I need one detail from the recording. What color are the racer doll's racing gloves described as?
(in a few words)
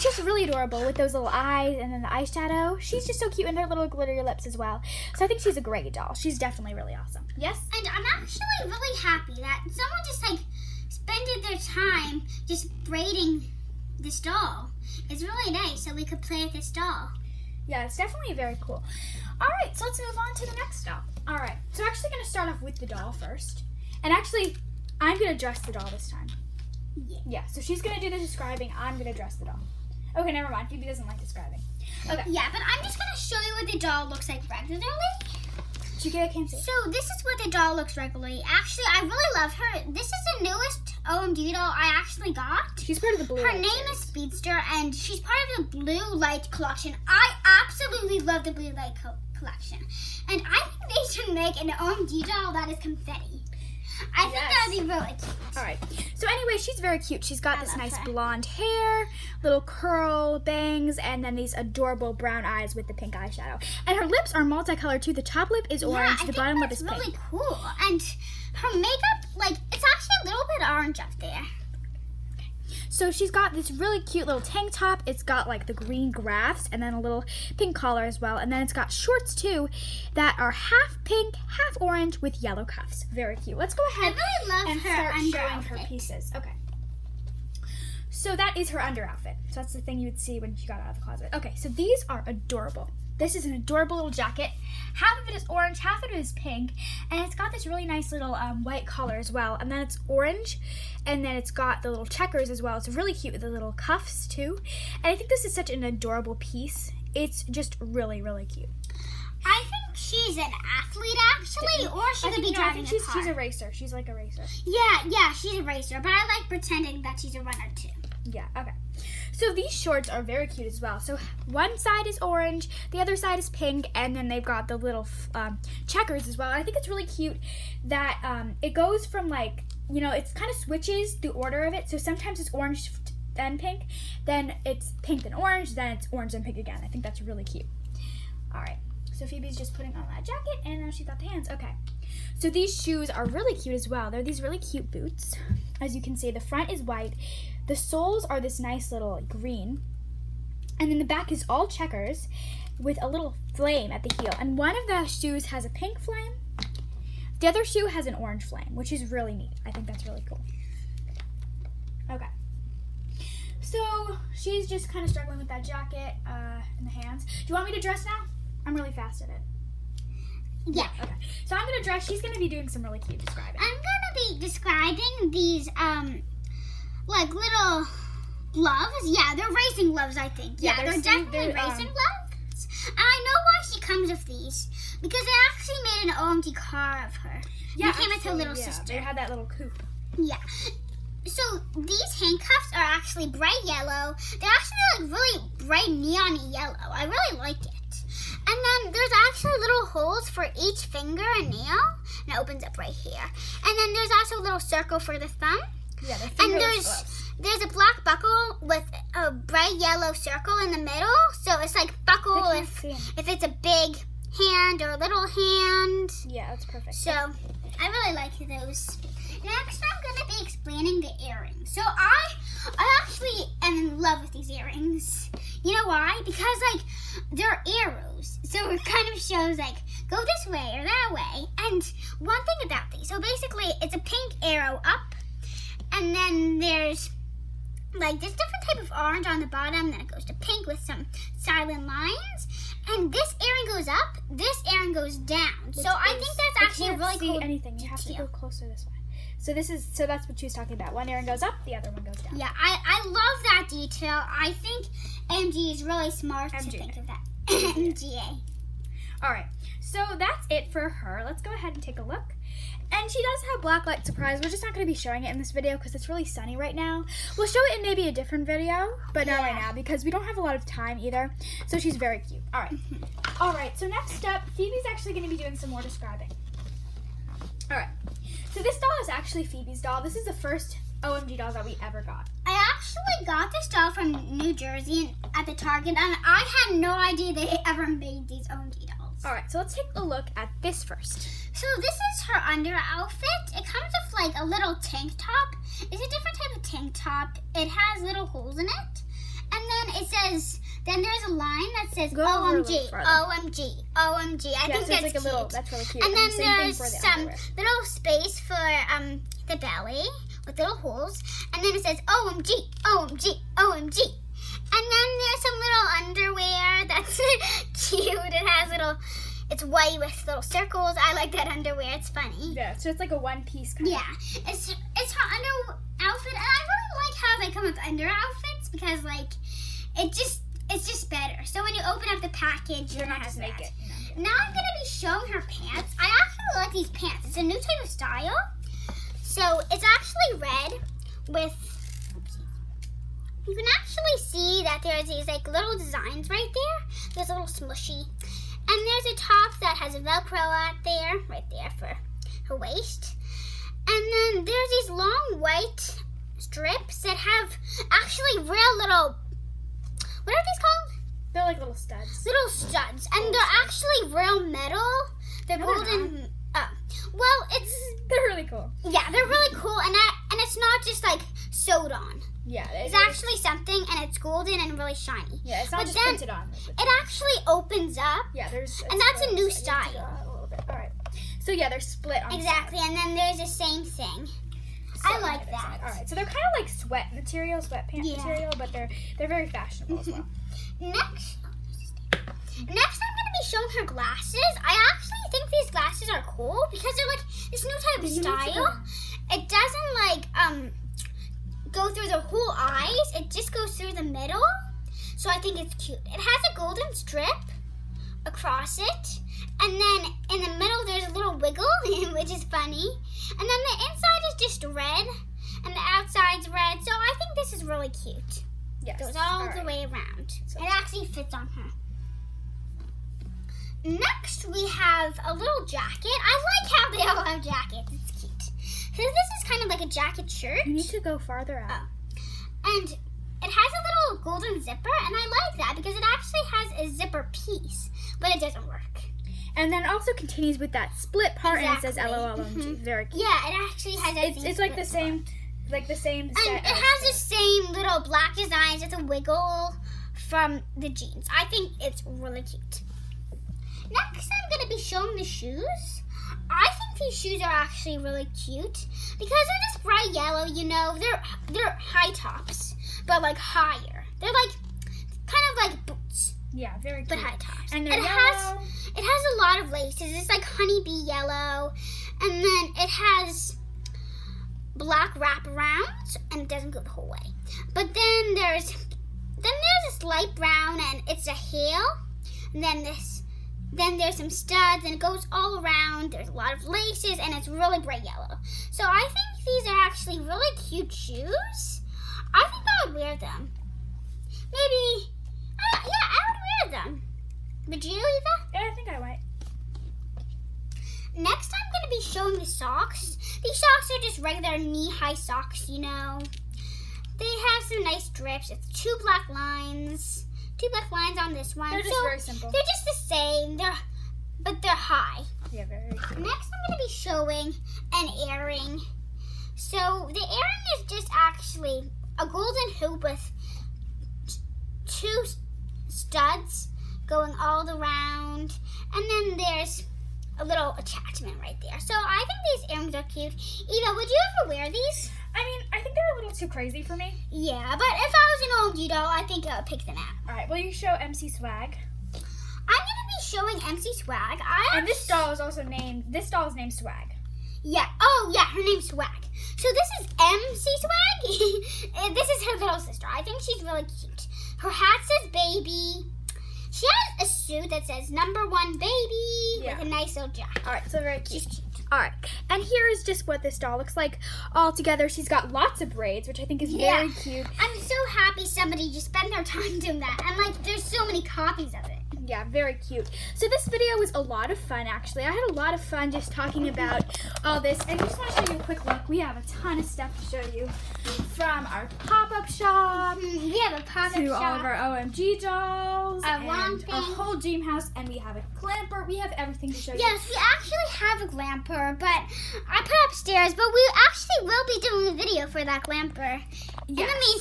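bright neon yellow.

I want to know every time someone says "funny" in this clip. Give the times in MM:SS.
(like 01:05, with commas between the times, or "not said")
05:22, 06:52.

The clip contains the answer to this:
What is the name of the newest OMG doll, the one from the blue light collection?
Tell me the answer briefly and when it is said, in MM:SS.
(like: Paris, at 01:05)
Speedster, at 00:43.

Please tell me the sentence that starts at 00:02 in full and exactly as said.
She's just so cute and her little glittery lips as well.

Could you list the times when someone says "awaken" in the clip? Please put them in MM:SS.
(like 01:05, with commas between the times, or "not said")
not said.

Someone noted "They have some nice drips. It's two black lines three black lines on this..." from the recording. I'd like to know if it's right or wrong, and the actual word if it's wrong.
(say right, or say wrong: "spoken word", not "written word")
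wrong: "two", not "three".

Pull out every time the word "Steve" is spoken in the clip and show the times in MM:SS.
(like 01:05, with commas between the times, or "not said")
not said.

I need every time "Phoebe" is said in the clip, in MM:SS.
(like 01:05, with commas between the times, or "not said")
00:30, 02:19, 04:34, 04:39.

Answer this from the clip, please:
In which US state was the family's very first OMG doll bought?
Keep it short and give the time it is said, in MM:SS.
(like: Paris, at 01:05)
New Jersey, at 04:44.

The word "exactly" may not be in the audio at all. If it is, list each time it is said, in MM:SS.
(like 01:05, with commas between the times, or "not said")
06:22, 07:21.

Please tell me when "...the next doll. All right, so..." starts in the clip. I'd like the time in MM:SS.
00:20.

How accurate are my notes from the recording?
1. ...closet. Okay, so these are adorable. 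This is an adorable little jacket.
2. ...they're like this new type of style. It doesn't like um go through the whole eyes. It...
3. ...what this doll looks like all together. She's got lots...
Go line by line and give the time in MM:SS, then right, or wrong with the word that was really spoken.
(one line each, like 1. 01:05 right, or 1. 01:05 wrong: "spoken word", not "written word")
1. 01:31 right
2. 06:36 right
3. 09:23 right.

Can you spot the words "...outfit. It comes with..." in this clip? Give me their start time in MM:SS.
04:52.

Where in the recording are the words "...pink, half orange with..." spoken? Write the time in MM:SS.
01:21.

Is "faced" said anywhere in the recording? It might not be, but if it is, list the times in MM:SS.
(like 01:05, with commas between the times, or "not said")
not said.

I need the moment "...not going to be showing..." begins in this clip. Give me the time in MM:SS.
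04:24.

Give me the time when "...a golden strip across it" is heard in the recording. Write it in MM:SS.
06:46.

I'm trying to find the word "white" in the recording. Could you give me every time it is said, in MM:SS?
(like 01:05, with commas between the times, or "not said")
01:38, 02:26, 05:19, 05:55.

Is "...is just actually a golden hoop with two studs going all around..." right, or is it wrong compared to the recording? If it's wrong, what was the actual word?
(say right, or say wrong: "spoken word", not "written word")
right.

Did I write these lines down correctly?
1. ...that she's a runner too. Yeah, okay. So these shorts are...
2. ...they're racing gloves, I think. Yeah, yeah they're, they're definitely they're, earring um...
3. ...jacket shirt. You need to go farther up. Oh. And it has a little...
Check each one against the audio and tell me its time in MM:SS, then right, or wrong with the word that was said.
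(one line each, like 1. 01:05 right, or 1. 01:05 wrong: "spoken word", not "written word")
1. 01:57 right
2. 02:59 wrong: "racing", not "earring"
3. 07:09 right.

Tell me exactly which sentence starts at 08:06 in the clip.
There's a lot of laces and it's really bright yellow.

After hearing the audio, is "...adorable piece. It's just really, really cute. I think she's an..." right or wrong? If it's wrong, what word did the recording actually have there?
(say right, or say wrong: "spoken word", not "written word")
right.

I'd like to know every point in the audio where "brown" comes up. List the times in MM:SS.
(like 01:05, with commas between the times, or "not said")
01:02, 08:00.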